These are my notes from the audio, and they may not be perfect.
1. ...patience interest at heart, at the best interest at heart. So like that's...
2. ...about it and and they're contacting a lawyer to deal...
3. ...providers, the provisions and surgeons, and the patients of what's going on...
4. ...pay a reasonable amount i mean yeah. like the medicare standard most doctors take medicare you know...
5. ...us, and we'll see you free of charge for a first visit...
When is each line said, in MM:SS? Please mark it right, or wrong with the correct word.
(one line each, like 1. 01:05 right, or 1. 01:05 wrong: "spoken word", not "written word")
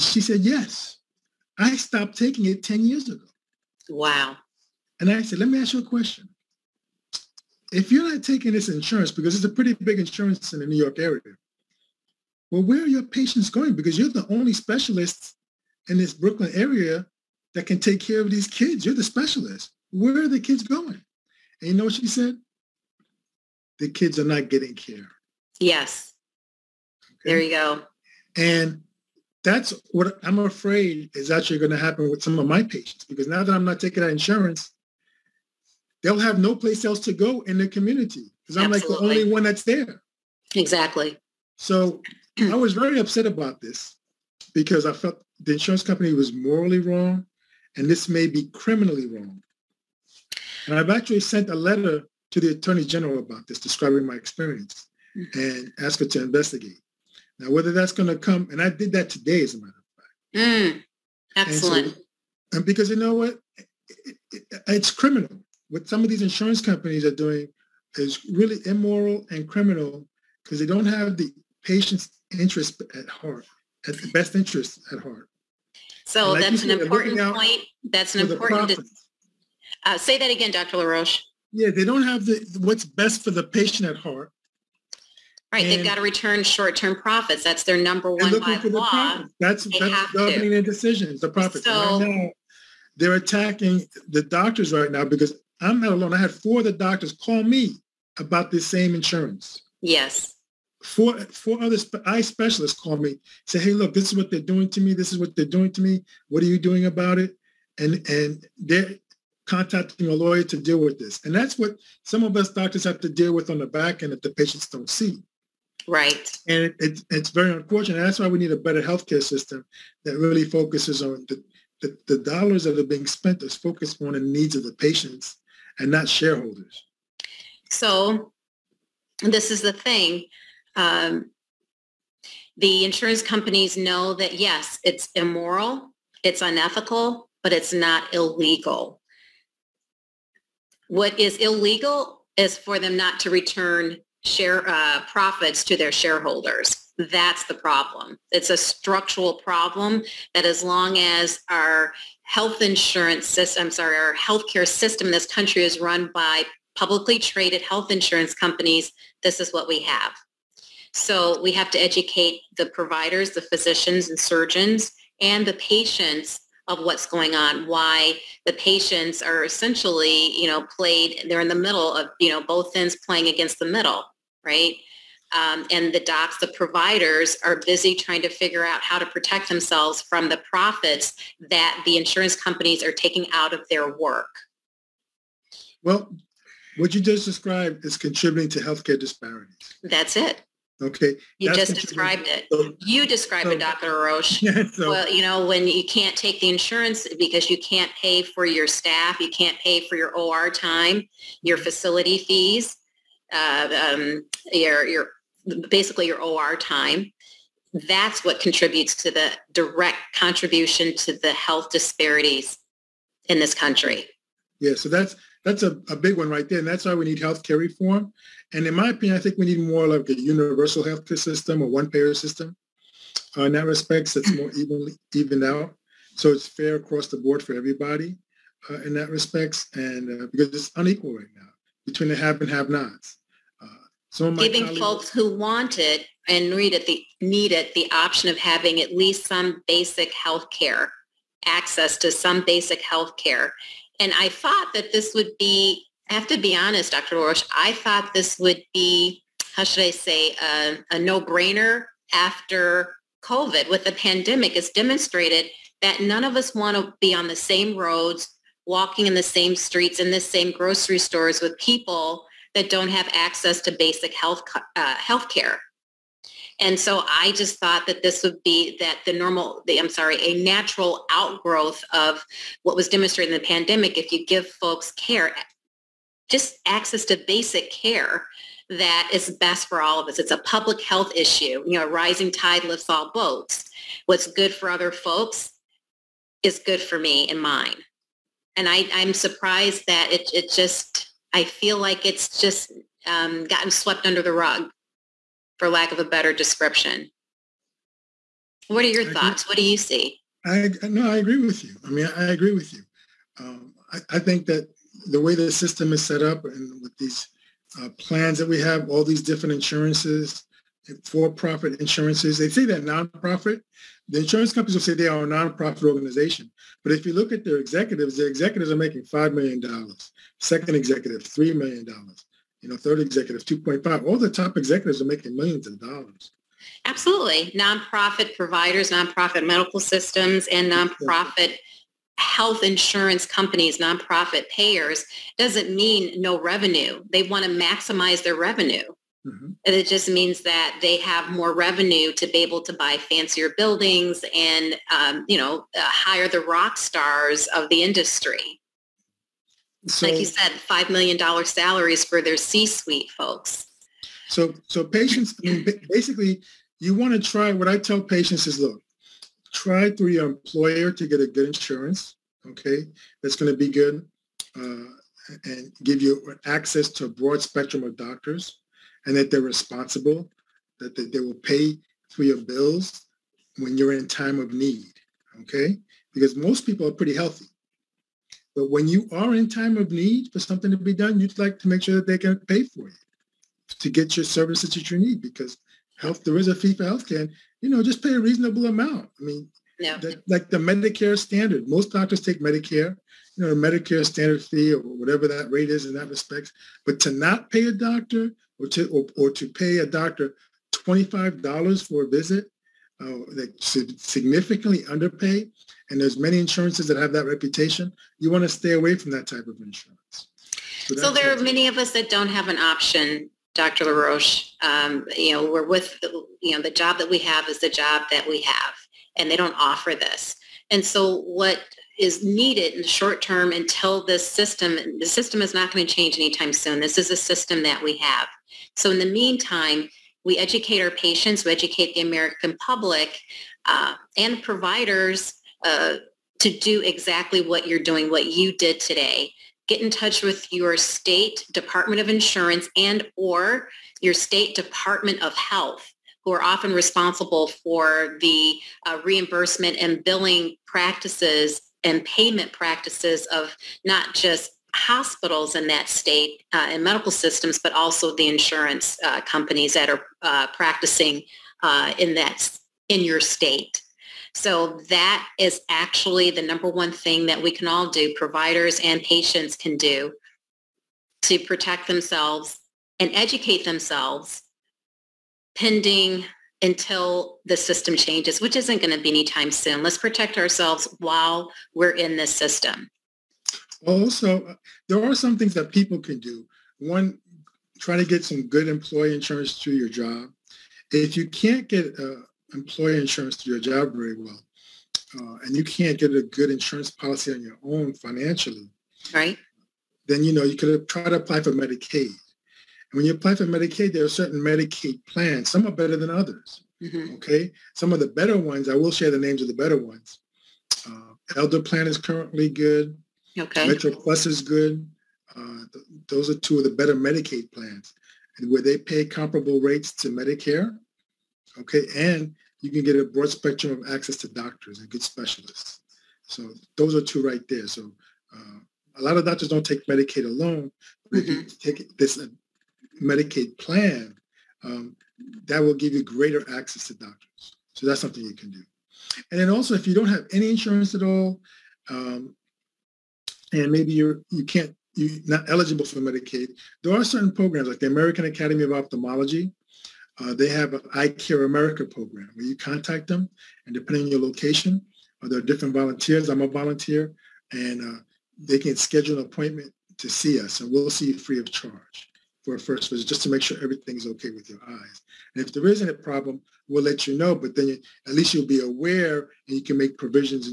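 1. 01:11 right
2. 01:46 right
3. 02:42 wrong: "physicians", not "provisions"
4. 06:28 right
5. 09:20 right.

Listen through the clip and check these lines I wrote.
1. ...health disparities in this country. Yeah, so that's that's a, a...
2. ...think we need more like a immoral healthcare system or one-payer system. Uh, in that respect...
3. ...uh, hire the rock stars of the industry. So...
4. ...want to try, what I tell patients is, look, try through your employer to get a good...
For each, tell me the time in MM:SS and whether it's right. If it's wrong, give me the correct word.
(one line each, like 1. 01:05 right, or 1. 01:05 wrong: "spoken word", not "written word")
1. 03:31 right
2. 03:39 wrong: "universal", not "immoral"
3. 05:45 right
4. 05:56 right.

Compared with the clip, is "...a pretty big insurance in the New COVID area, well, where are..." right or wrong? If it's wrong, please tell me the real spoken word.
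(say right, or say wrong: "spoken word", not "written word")
wrong: "York", not "COVID".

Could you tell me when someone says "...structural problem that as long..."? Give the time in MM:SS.
02:28.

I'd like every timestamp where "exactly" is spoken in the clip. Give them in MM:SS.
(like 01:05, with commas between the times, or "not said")
00:40, 07:16.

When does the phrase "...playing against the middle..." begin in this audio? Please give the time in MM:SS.
02:53.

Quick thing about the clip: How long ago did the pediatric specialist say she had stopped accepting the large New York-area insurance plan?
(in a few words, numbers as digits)
10 years.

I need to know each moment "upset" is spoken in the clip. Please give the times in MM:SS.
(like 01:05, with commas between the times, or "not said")
00:42.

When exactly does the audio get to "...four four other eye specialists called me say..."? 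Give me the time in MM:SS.
01:40.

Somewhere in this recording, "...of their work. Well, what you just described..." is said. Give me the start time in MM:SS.
03:03.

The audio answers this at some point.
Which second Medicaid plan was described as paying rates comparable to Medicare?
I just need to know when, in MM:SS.
08:33.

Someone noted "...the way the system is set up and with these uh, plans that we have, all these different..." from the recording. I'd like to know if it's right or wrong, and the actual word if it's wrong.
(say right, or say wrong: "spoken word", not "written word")
right.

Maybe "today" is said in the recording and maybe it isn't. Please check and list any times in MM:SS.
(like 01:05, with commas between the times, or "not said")
00:59, 07:18.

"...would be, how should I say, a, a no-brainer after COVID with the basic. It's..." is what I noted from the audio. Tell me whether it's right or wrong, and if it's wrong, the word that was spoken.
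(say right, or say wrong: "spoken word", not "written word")
wrong: "pandemic", not "basic".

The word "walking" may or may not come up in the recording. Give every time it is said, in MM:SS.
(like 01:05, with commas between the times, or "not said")
04:18.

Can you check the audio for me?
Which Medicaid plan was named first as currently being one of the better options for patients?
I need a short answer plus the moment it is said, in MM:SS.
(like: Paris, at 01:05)
Elder Plan, at 08:31.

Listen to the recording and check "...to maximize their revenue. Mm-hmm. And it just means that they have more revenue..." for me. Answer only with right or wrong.
right.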